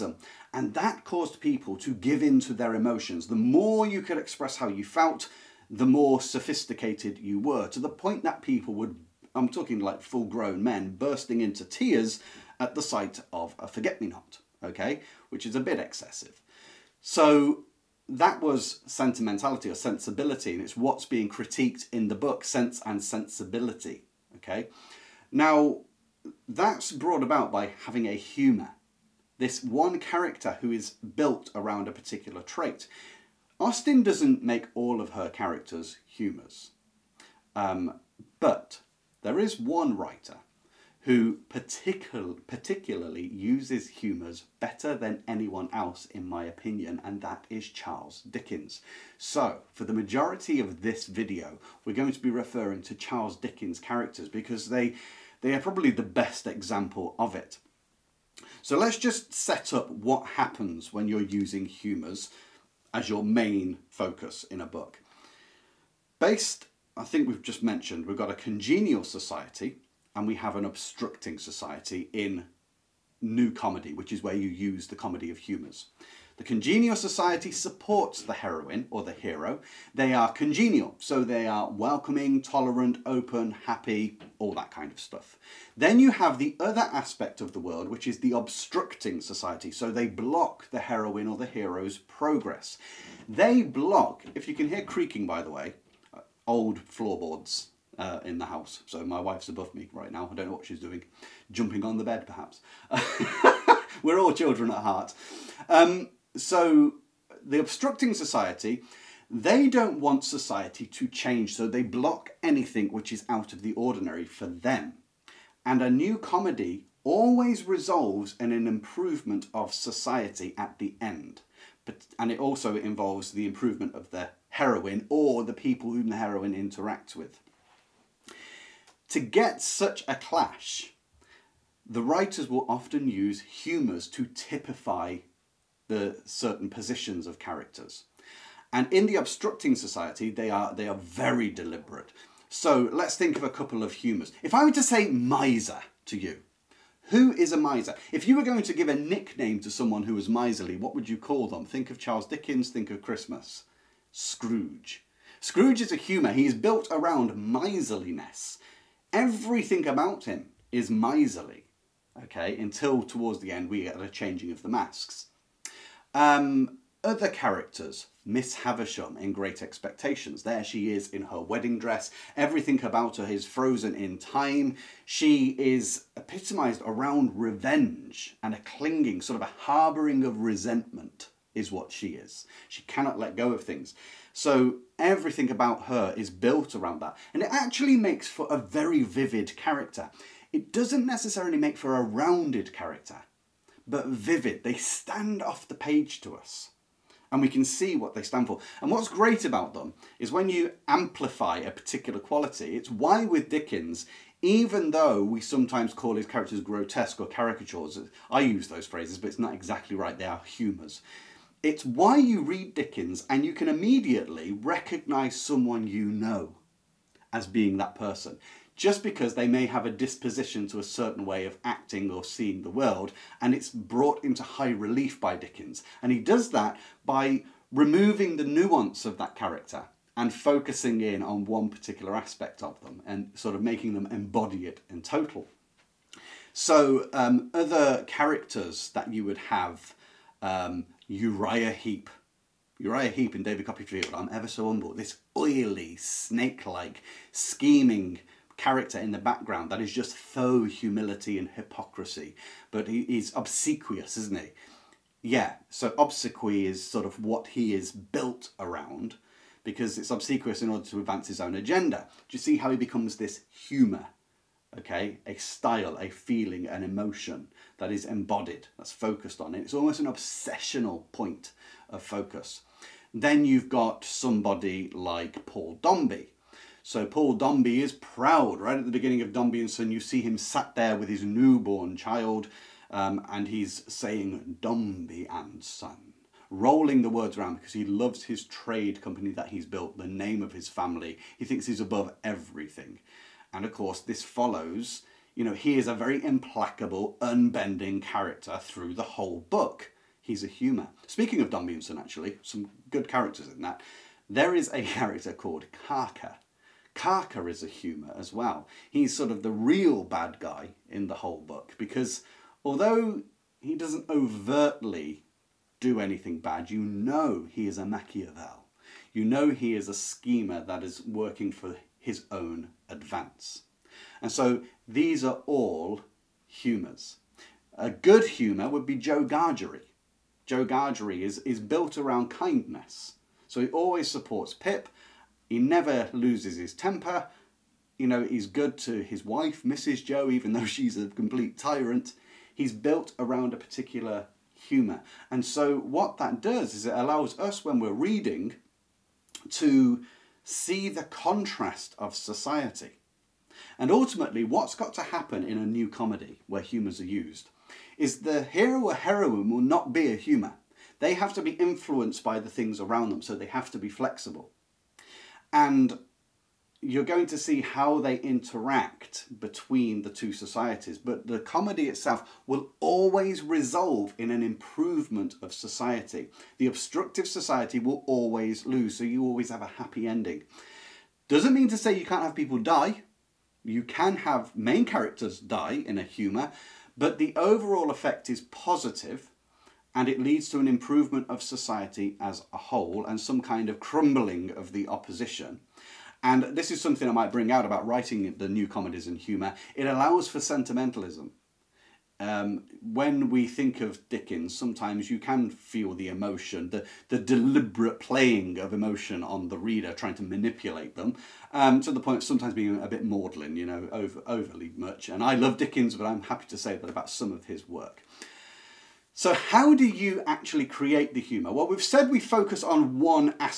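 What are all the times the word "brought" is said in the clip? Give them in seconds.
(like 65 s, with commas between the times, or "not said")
26 s, 223 s.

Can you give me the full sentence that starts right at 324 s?
And so these are all humours.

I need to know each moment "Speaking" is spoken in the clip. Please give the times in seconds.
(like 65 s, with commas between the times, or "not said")
301 s.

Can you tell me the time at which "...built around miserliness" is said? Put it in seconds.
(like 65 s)
156 s.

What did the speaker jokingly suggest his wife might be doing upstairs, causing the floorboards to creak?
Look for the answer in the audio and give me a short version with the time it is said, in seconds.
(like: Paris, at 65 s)
Jumping on the bed, at 101 s.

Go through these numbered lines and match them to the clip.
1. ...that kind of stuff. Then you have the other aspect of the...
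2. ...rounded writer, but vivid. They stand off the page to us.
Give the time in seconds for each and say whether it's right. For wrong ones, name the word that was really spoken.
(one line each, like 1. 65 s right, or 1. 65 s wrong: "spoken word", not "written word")
1. 84 s right
2. 192 s wrong: "character", not "writer".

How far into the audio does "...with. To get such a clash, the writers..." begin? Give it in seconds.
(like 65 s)
127 s.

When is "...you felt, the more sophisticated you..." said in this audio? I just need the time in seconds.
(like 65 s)
4 s.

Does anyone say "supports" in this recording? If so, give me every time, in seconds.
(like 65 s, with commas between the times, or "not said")
77 s, 334 s.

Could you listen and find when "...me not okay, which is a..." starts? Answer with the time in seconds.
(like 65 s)
13 s.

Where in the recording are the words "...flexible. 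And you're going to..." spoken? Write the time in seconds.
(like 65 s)
363 s.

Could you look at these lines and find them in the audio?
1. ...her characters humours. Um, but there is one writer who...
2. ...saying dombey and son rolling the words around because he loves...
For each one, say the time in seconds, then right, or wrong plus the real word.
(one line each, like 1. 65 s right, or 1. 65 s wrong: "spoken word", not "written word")
1. 35 s right
2. 283 s right.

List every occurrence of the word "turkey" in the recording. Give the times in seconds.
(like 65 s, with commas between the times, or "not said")
not said.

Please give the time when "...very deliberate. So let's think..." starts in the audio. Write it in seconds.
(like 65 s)
140 s.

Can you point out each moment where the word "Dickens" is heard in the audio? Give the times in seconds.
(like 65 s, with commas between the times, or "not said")
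48 s, 53 s, 152 s, 203 s, 212 s, 225 s, 404 s, 415 s.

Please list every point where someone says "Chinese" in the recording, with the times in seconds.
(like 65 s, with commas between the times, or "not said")
not said.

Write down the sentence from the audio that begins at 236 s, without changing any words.
So, um, other characters that you would have um, Uriah Heep.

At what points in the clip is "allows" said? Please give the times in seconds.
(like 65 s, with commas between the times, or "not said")
346 s, 399 s.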